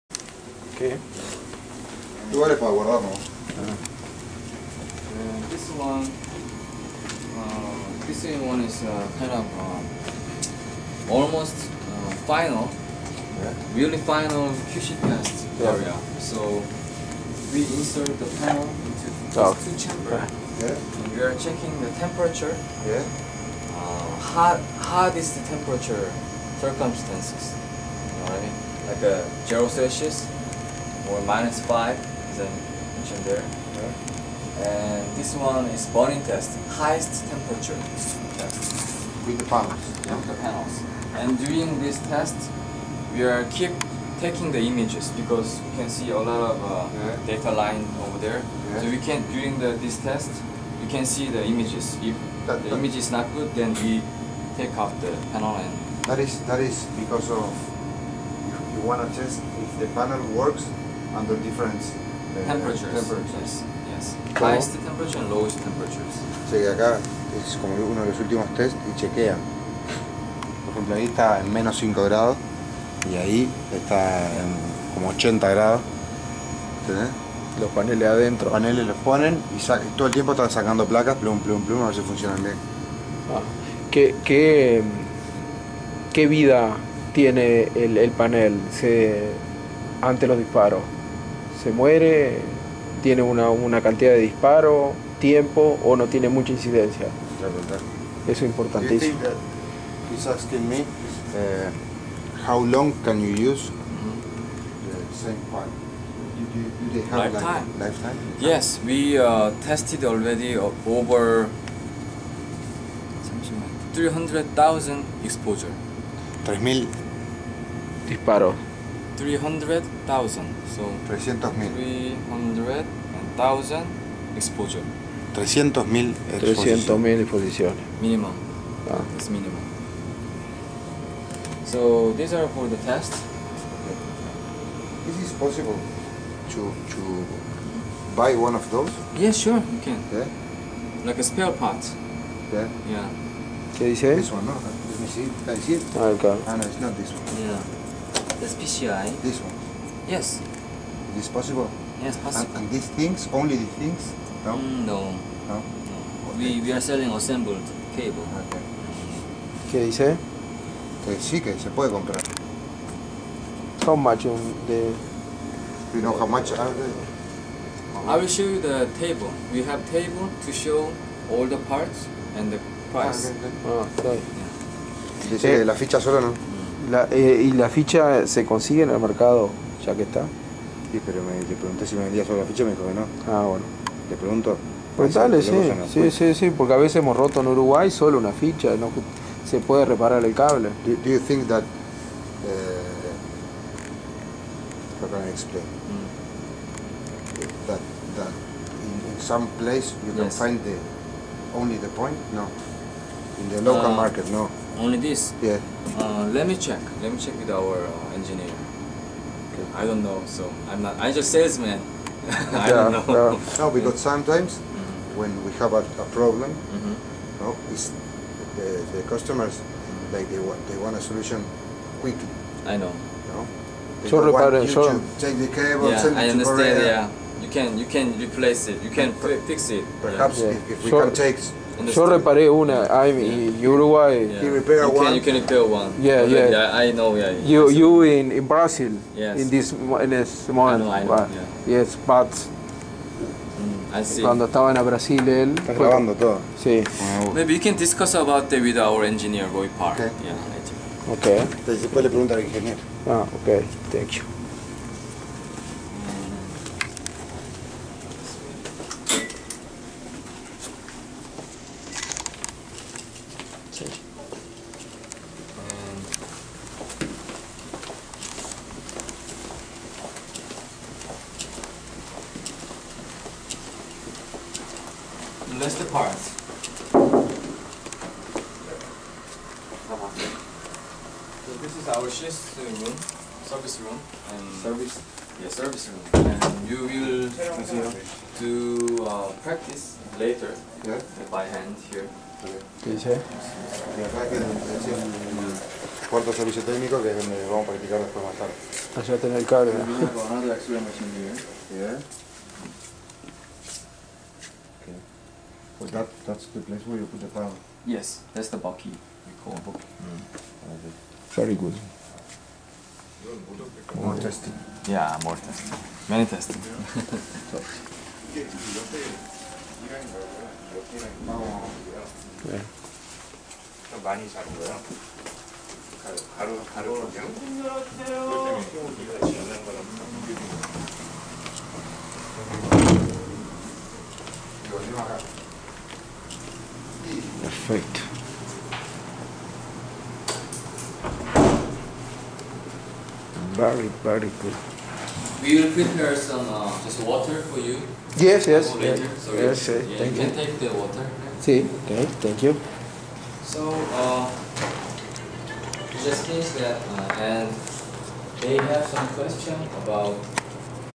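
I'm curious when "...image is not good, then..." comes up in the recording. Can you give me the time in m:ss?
0:52.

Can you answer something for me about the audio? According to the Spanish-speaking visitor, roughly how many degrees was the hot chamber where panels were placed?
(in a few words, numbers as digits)
80.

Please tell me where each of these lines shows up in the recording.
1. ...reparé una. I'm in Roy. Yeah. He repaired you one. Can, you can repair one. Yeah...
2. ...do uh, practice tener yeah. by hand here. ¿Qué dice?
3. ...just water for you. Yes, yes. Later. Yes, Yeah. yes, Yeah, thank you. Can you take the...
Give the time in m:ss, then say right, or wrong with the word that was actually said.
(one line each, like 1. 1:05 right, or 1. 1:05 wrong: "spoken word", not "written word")
1. 3:52 wrong: "Uruguay", not "Roy"
2. 4:48 wrong: "later", not "tener"
3. 5:46 wrong: "Sorry", not "Yeah".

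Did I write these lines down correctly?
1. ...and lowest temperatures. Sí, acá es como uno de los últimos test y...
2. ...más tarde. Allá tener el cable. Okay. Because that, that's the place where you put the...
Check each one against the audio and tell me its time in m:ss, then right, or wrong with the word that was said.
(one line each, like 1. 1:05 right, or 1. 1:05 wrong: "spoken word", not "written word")
1. 1:05 right
2. 4:58 right.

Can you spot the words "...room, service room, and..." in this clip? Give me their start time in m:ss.
4:42.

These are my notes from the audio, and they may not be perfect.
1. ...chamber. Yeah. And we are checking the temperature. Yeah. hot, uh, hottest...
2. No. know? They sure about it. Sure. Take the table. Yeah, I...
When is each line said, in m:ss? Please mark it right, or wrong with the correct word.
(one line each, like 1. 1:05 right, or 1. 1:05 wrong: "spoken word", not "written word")
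1. 0:19 right
2. 3:43 wrong: "cable", not "table".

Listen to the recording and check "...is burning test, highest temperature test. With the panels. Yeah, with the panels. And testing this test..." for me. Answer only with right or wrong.
wrong.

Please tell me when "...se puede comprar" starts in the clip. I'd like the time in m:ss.
2:41.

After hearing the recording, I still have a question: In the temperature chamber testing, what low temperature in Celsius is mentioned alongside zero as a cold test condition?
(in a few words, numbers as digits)
-5.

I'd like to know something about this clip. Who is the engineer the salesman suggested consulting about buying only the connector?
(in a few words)
Roy Park.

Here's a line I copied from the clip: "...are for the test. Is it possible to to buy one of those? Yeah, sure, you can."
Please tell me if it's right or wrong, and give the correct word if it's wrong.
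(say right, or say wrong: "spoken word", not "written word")
right.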